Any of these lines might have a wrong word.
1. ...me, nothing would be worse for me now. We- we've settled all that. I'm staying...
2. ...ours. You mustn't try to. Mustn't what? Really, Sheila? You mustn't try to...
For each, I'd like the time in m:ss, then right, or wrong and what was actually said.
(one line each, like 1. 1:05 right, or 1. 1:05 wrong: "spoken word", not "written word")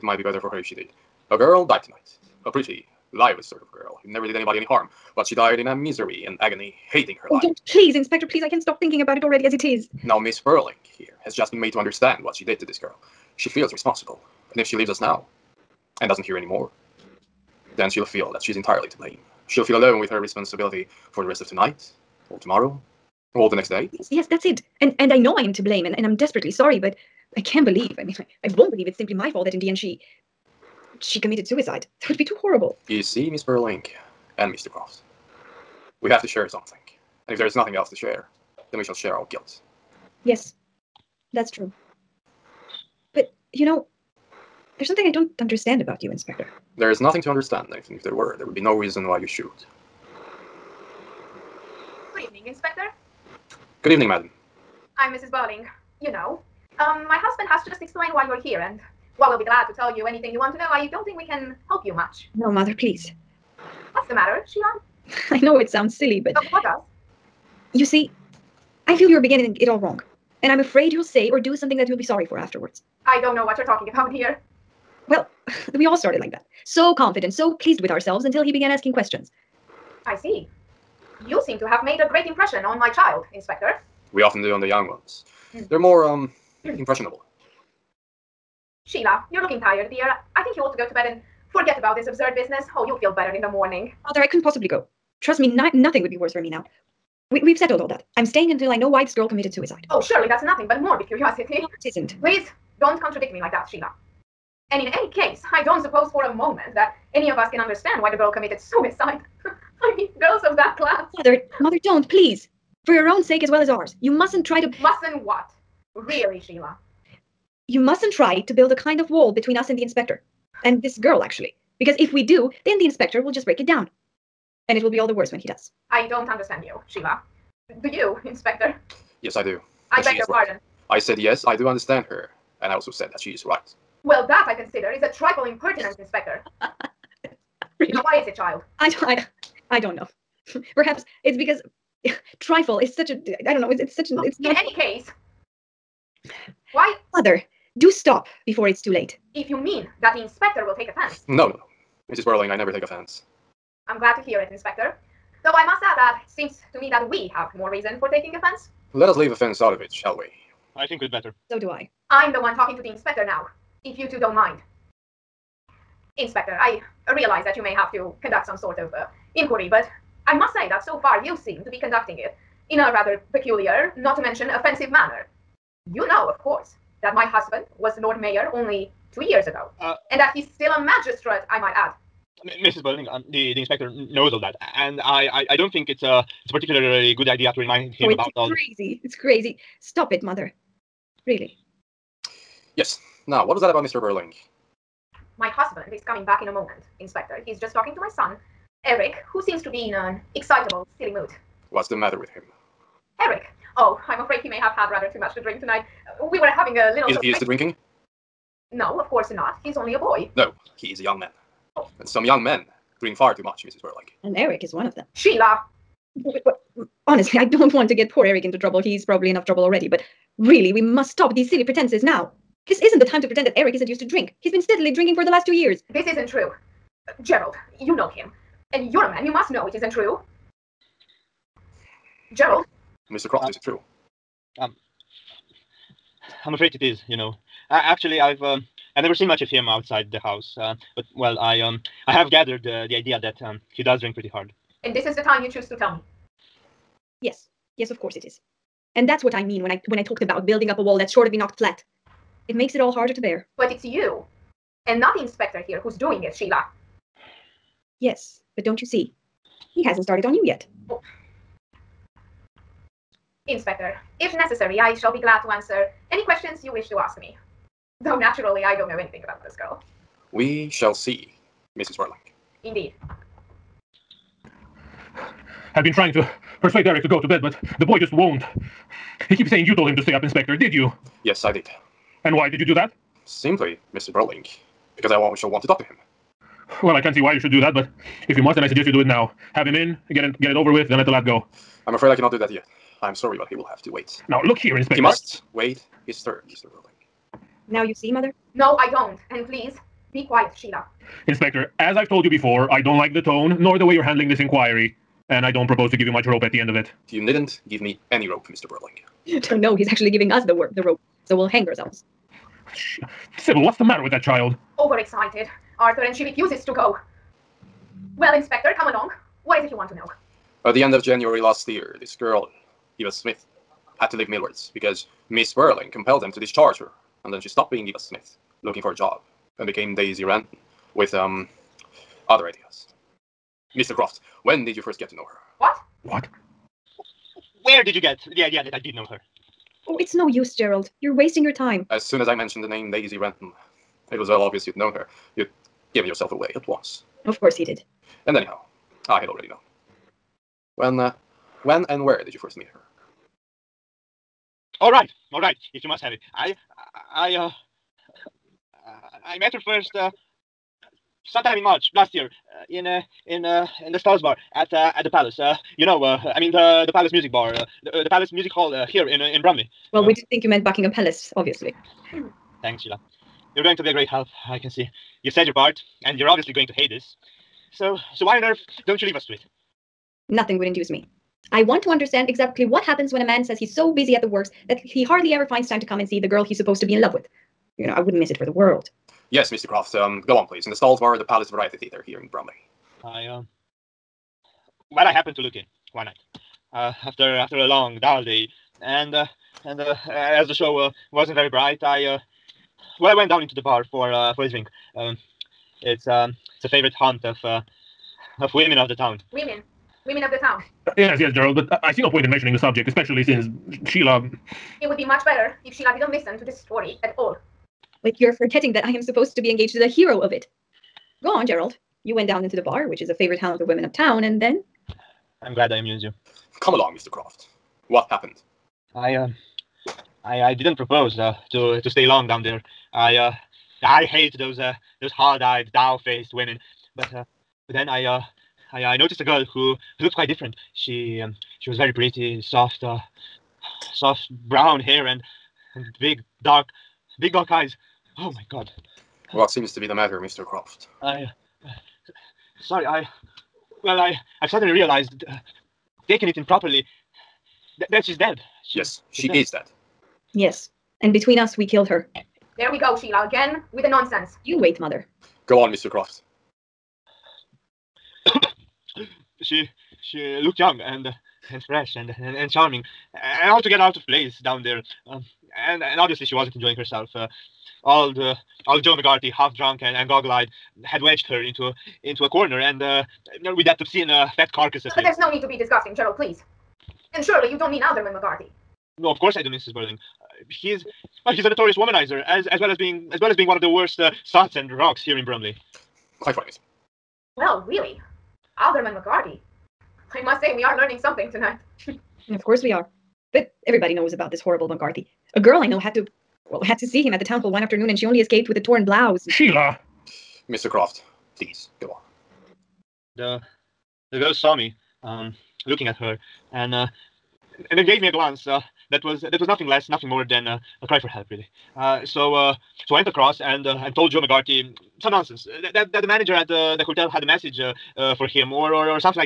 1. 1:35 right
2. 1:53 right.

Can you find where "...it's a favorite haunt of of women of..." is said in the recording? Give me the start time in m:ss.
6:46.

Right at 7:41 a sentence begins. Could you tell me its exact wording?
And between us, we killed her.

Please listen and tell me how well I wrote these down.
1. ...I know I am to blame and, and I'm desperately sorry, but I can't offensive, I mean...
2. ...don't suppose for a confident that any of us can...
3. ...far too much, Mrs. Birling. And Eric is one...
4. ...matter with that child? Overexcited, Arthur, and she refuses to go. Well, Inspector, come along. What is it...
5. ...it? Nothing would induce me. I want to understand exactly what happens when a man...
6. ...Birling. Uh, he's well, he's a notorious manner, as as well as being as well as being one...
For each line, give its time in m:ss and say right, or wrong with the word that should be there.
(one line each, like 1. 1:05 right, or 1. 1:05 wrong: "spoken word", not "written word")
1. 0:25 wrong: "believe", not "offensive"
2. 1:45 wrong: "moment", not "confident"
3. 3:33 right
4. 5:13 right
5. 6:19 right
6. 8:09 wrong: "womanizer", not "manner".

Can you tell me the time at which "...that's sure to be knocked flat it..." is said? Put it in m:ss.
4:10.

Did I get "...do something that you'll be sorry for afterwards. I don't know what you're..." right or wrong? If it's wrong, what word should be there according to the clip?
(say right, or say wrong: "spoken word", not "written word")
right.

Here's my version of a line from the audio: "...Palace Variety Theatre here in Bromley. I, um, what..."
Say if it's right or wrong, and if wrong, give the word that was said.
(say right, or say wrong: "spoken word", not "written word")
right.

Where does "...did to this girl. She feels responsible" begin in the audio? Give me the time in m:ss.
0:12.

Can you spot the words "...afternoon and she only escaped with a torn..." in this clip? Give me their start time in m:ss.
8:27.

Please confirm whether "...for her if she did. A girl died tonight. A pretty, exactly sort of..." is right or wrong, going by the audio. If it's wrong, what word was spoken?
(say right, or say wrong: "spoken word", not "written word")
wrong: "lively", not "exactly".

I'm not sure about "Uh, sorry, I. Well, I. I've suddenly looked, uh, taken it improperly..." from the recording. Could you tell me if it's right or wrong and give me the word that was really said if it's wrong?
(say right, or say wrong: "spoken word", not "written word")
wrong: "realized", not "looked".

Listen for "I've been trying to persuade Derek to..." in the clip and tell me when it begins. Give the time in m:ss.
4:35.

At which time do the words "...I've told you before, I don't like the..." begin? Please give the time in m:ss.
5:01.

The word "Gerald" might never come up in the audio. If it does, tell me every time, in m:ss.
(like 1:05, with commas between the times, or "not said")
3:47, 3:52, 5:40, 6:51, 7:01, 8:05.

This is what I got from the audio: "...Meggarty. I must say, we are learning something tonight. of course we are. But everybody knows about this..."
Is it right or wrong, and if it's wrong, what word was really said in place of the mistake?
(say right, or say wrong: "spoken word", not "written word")
right.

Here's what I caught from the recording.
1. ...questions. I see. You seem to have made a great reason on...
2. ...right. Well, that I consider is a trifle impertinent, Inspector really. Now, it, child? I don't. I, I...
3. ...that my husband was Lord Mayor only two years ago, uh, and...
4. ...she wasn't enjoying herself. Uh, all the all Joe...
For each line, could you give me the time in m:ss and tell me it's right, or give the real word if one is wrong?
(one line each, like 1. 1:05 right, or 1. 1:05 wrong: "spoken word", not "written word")
1. 1:18 wrong: "impression", not "reason"
2. 2:13 right
3. 2:57 right
4. 7:56 right.